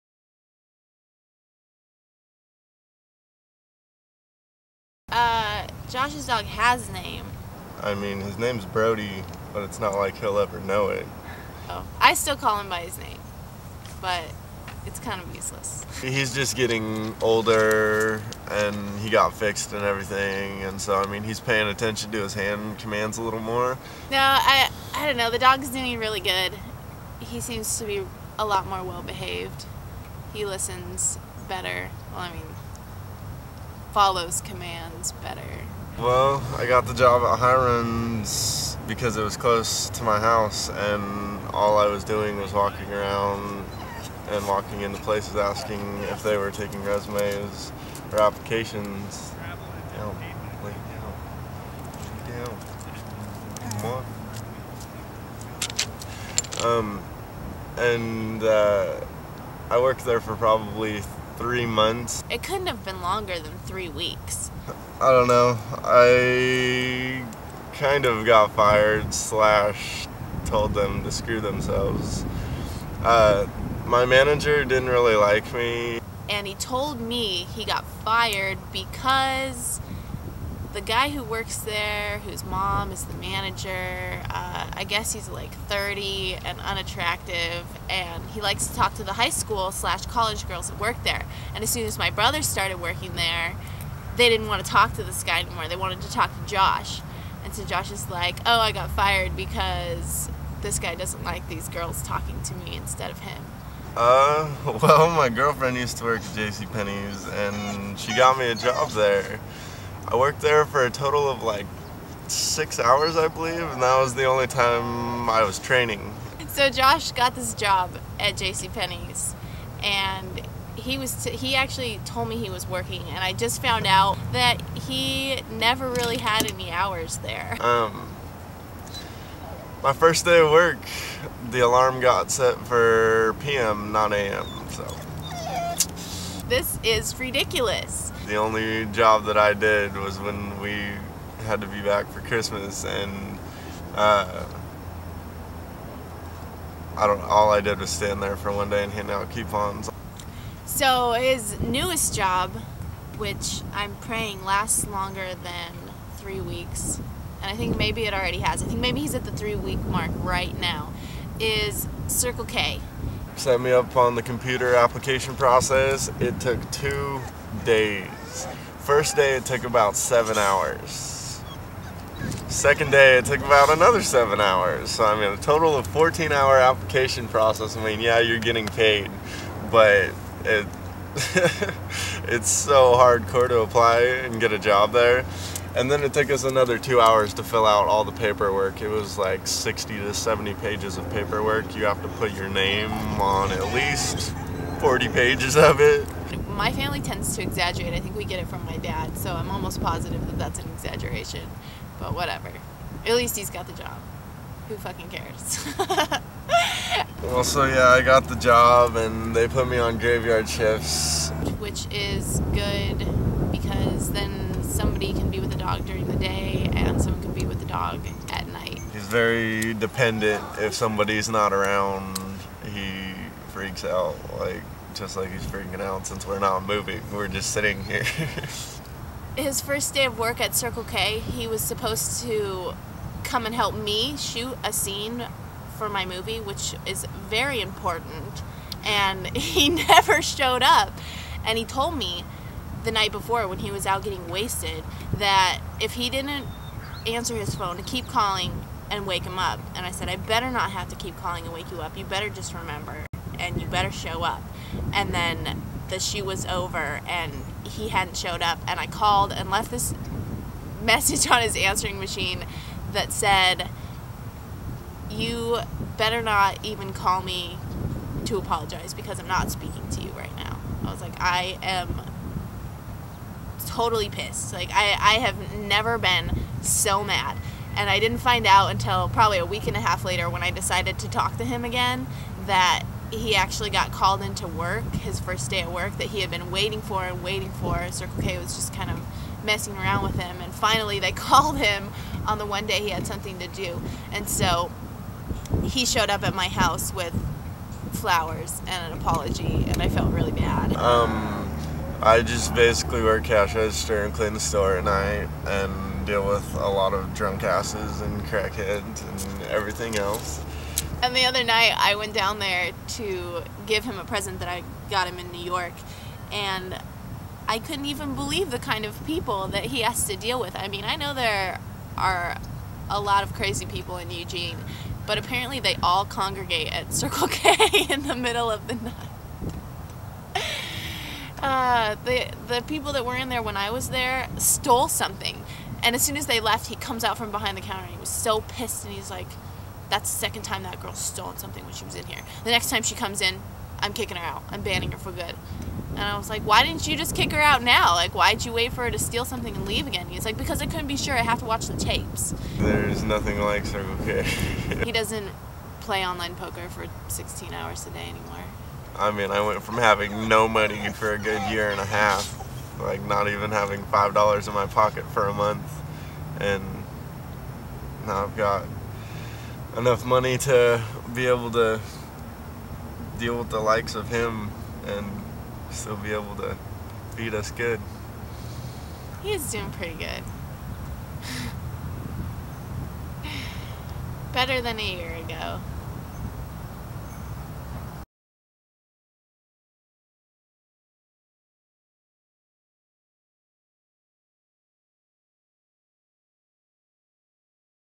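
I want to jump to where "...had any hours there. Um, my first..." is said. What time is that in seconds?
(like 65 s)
126 s.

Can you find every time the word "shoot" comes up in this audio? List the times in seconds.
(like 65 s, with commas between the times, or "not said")
234 s, 255 s.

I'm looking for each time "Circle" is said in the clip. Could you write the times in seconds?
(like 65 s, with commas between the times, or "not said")
162 s, 230 s, 287 s, 326 s, 353 s.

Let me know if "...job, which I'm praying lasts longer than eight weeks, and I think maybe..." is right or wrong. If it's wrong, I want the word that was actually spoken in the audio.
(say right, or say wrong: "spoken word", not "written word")
wrong: "three", not "eight".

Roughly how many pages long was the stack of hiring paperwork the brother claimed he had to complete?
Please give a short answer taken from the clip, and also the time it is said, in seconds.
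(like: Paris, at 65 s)
60 to 70, at 189 s.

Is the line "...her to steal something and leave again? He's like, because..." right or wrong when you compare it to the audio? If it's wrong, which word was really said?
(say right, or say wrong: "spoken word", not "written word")
right.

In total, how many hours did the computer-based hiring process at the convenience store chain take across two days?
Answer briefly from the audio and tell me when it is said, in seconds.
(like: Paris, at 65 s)
14, at 175 s.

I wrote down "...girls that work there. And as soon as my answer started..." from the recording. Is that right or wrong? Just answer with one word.
wrong.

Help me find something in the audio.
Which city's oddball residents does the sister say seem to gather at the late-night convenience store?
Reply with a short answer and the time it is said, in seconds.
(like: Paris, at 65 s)
Eugene, at 324 s.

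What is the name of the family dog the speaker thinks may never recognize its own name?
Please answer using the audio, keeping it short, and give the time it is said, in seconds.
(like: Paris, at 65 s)
Brodie, at 8 s.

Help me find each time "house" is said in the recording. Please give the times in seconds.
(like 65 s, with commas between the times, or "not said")
40 s, 296 s.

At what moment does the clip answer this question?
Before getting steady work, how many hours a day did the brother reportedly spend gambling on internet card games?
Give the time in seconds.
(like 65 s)
357 s.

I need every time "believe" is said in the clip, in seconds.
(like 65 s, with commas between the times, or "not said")
113 s, 318 s.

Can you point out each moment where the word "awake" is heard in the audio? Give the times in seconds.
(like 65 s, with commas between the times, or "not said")
not said.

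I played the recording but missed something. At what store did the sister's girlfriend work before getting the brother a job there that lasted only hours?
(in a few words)
JCPenney's.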